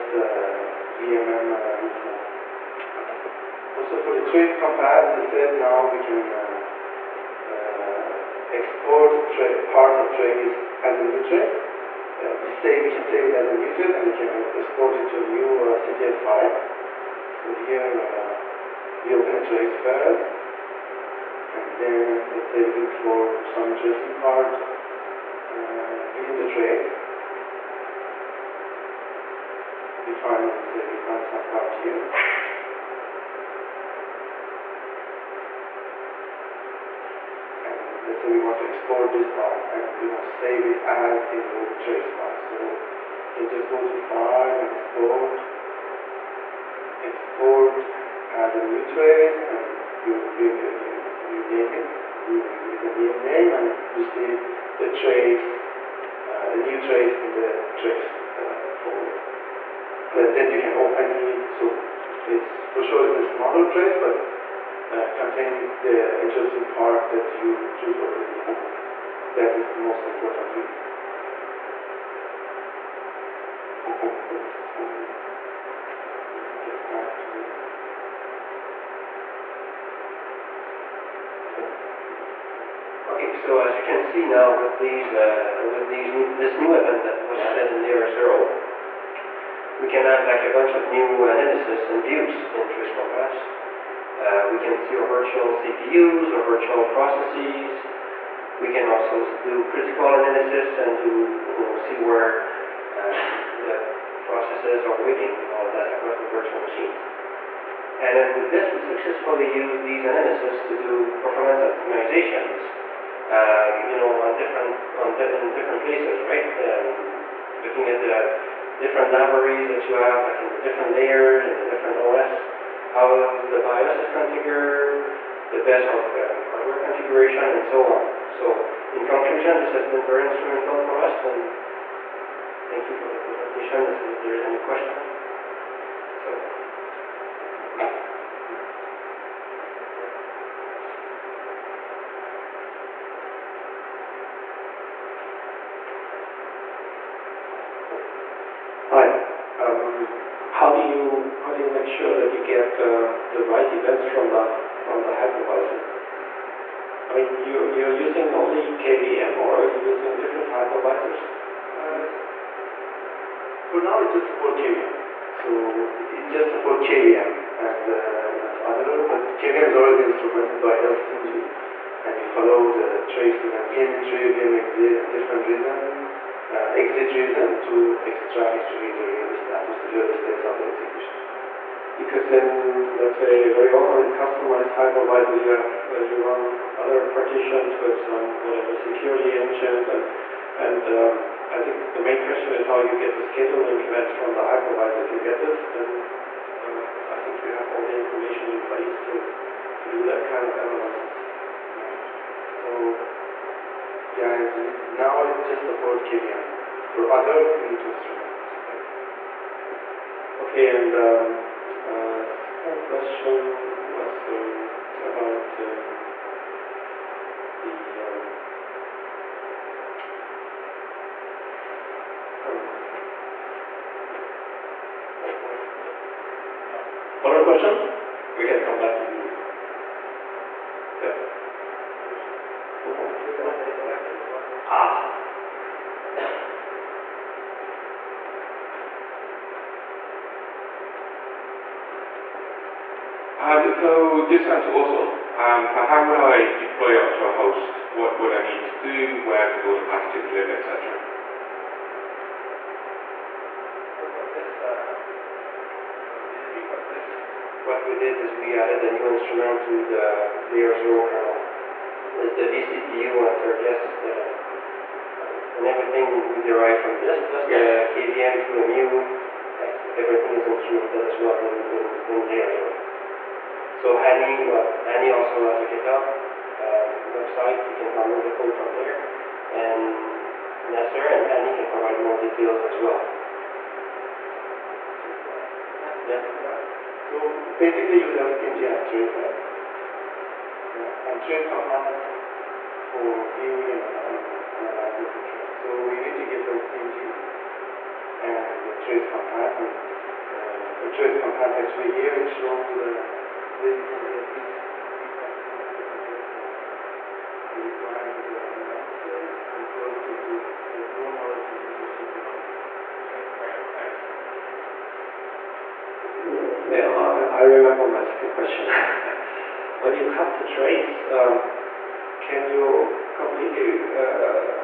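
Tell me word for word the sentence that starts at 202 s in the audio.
So, yeah, it's now it just support KVM for other Linux instruments.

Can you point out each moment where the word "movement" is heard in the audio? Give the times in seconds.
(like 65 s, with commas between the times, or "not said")
1 s.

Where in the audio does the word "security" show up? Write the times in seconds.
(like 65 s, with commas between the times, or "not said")
188 s.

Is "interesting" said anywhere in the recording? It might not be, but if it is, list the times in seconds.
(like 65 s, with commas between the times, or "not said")
23 s, 66 s.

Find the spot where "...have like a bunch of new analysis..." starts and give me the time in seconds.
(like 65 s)
90 s.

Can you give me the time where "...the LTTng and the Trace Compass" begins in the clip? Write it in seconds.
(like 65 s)
296 s.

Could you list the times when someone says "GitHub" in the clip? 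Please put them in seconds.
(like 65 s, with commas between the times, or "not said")
275 s.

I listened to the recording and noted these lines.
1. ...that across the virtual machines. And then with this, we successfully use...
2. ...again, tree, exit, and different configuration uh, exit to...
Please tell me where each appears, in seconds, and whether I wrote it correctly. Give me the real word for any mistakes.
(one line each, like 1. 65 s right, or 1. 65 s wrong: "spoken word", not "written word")
1. 105 s right
2. 173 s wrong: "reason", not "configuration".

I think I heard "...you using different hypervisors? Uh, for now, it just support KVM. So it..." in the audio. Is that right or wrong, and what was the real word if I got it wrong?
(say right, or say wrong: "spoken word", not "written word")
right.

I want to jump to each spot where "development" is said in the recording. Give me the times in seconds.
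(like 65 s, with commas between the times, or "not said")
not said.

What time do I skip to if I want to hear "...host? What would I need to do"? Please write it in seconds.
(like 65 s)
247 s.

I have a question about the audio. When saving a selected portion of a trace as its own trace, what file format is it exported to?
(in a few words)
CTF.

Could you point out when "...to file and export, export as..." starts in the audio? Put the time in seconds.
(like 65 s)
43 s.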